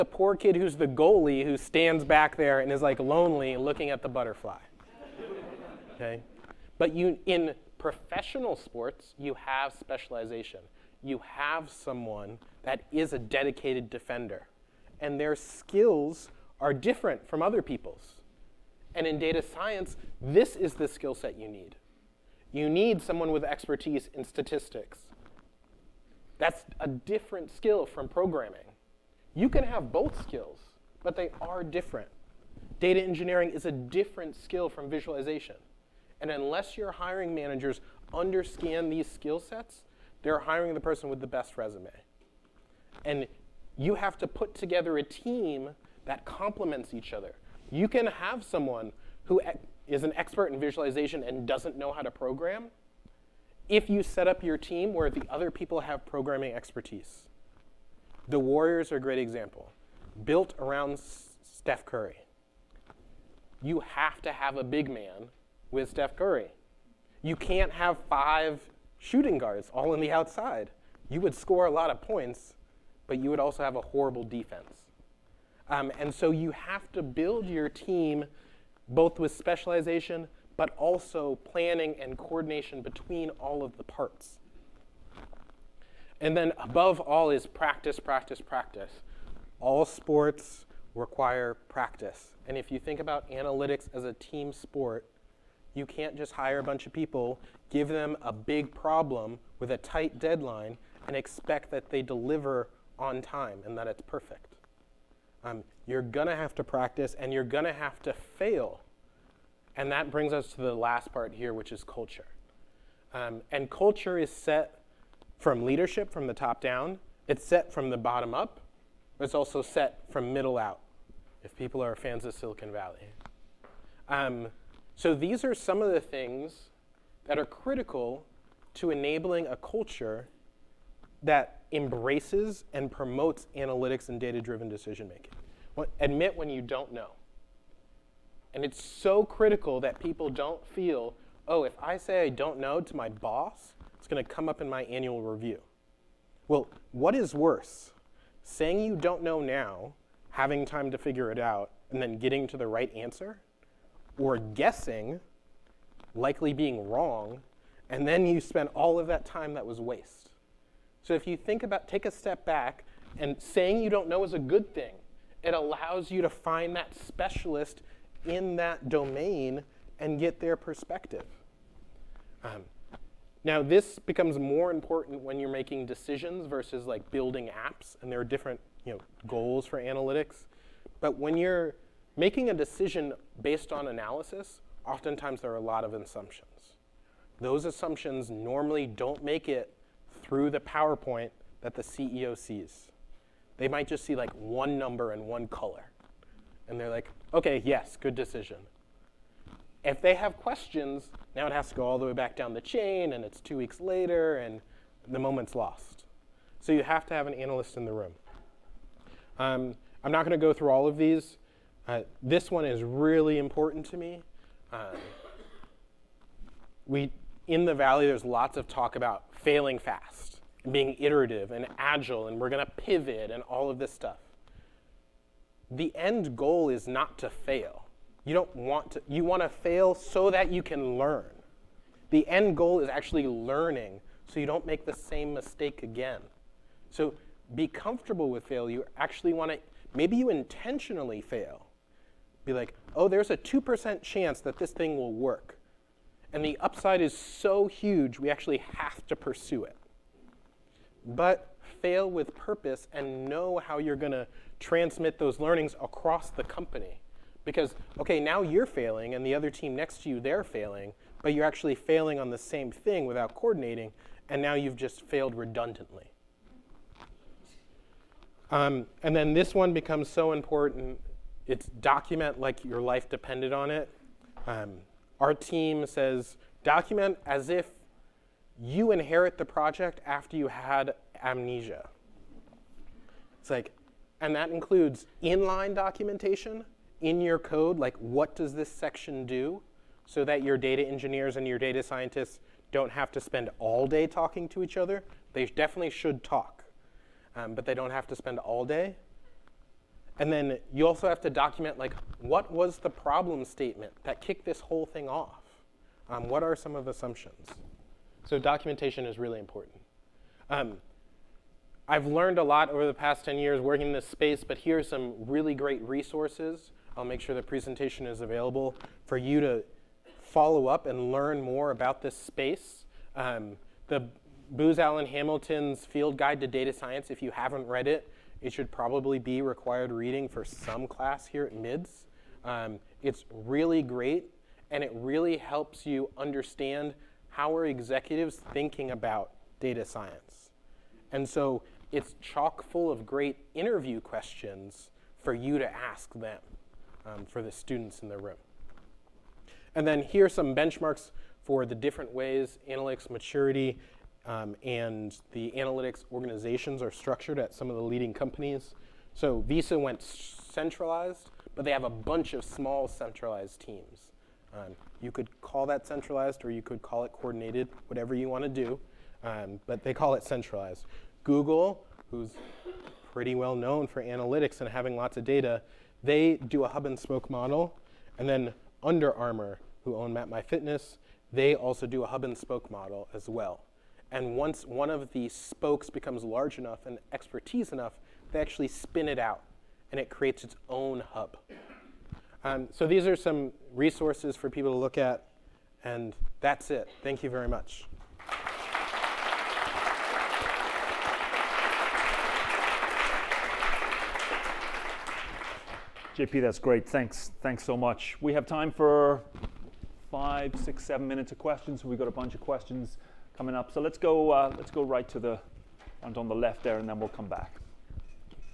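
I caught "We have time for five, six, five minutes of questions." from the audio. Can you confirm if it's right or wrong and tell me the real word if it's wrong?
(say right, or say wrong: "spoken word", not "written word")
wrong: "seven", not "five".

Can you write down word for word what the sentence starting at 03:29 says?
Um, I'm not going to go through all of these.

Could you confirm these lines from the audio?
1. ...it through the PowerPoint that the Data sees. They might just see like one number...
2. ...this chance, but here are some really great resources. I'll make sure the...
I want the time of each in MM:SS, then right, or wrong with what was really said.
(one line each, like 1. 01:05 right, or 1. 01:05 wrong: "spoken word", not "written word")
1. 03:09 wrong: "CEO", not "Data"
2. 05:13 wrong: "space", not "chance".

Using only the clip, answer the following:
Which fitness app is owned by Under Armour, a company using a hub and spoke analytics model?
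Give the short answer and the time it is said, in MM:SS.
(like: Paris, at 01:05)
MapMyFitness, at 06:20.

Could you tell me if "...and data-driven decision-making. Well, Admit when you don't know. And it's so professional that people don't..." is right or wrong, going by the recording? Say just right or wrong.
wrong.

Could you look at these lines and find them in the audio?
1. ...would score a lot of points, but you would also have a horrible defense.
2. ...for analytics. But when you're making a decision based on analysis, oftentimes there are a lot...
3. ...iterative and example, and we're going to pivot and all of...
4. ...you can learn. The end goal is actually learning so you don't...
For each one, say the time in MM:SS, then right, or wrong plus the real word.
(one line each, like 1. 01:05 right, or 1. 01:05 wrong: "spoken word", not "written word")
1. 01:11 right
2. 02:59 right
3. 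03:40 wrong: "agile", not "example"
4. 03:50 right.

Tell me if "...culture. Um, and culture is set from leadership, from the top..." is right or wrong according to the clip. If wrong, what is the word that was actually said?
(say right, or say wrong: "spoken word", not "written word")
right.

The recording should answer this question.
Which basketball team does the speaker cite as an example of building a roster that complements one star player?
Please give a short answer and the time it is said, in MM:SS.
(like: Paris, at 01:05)
The Warriors, at 00:58.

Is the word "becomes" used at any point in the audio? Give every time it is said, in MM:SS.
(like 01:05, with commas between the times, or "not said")
02:53, 04:29, 06:25.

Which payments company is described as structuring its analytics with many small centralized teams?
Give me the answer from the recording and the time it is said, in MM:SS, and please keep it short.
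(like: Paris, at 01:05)
Visa, at 05:59.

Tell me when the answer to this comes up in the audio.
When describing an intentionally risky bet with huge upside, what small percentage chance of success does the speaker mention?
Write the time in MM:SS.
04:03.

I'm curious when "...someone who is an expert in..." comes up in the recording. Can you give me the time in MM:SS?
00:48.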